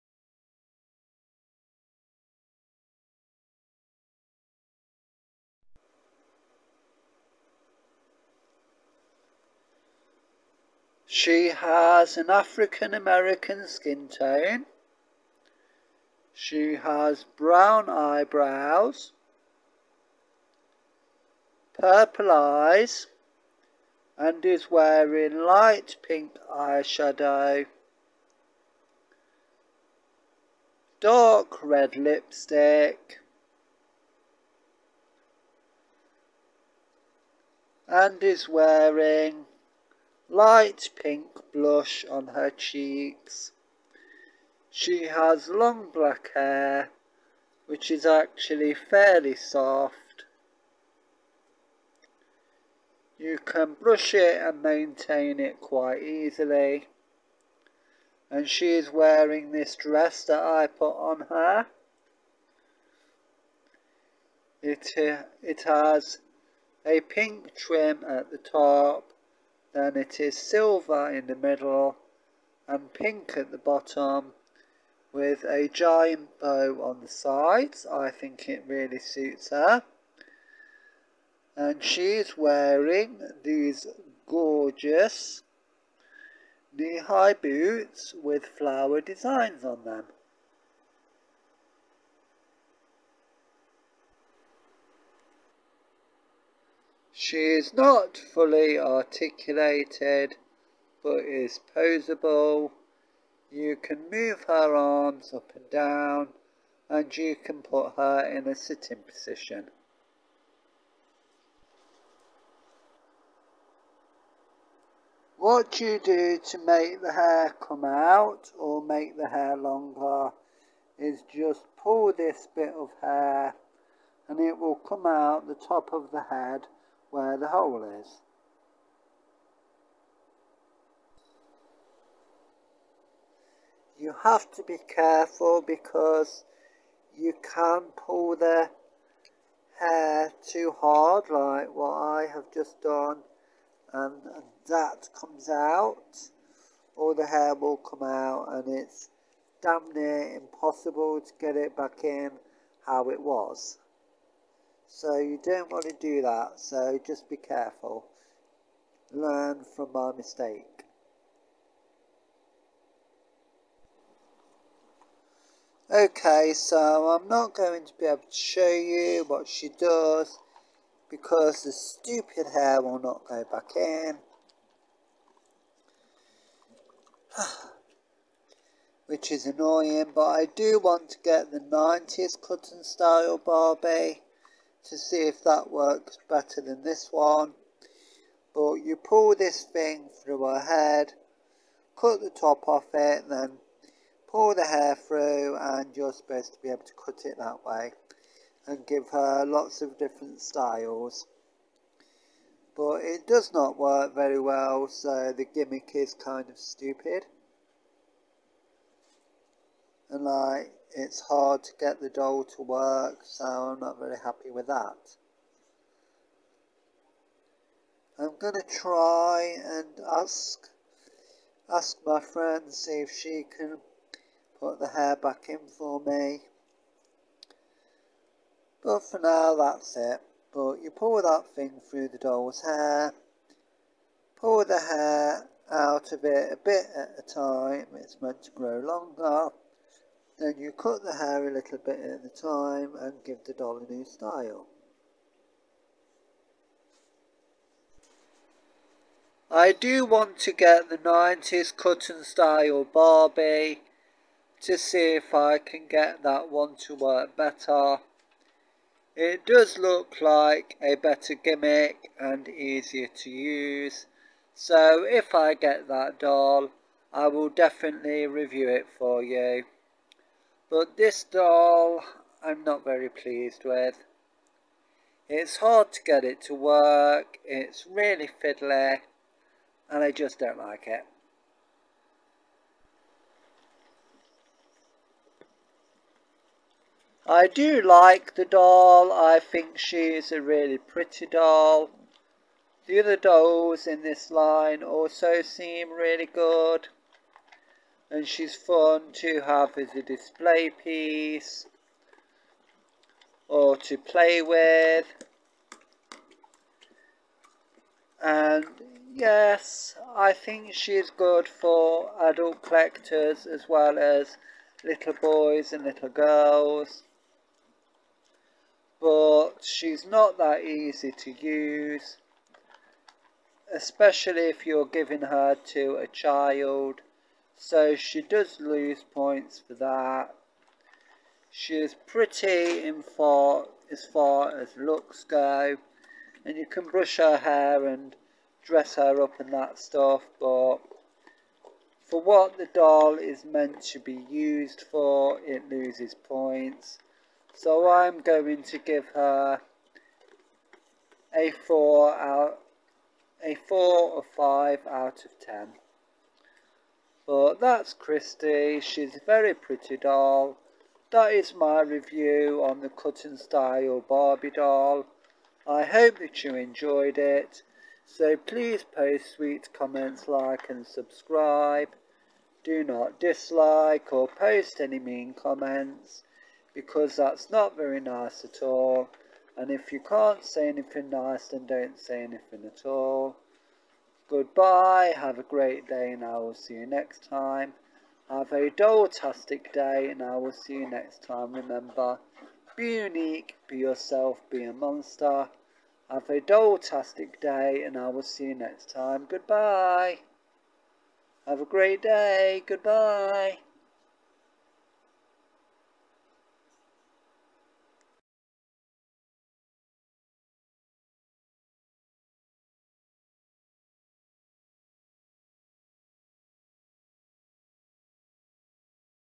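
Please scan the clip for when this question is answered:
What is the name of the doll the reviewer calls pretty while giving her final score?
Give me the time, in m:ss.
5:57.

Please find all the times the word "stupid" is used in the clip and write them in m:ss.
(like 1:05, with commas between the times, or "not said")
2:51, 3:26.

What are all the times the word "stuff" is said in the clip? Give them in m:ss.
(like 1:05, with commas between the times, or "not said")
5:39.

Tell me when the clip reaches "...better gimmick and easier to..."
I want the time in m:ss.
4:20.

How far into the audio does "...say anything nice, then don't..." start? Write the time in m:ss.
6:20.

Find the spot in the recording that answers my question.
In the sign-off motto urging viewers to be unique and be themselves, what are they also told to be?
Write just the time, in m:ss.
6:34.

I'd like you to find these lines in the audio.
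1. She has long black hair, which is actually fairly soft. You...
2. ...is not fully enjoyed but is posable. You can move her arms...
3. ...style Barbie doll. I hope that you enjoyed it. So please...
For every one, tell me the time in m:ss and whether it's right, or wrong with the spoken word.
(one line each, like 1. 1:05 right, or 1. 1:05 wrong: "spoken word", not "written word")
1. 0:44 right
2. 1:37 wrong: "articulated", not "enjoyed"
3. 6:03 right.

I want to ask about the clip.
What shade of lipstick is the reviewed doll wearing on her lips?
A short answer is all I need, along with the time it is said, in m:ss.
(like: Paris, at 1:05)
Dark red, at 0:31.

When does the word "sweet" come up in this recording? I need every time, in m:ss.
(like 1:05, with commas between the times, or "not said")
6:09.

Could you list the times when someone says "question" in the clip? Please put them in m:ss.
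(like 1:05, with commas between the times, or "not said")
not said.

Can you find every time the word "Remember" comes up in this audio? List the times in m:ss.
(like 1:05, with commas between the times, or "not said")
6:31.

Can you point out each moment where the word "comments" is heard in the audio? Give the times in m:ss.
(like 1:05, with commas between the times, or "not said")
6:09, 6:15.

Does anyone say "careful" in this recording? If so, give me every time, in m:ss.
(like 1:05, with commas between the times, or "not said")
2:14, 2:37.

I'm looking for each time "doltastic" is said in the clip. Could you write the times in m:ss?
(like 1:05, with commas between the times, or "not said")
6:28, 6:36.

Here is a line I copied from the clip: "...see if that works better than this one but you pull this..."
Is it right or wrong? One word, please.
right.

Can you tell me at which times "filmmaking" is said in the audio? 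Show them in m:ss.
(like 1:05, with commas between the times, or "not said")
not said.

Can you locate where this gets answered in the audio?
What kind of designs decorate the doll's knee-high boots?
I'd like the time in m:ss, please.
1:28.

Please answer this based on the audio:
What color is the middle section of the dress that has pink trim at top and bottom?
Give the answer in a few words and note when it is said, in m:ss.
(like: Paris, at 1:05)
Silver, at 1:10.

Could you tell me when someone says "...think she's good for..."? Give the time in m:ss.
5:10.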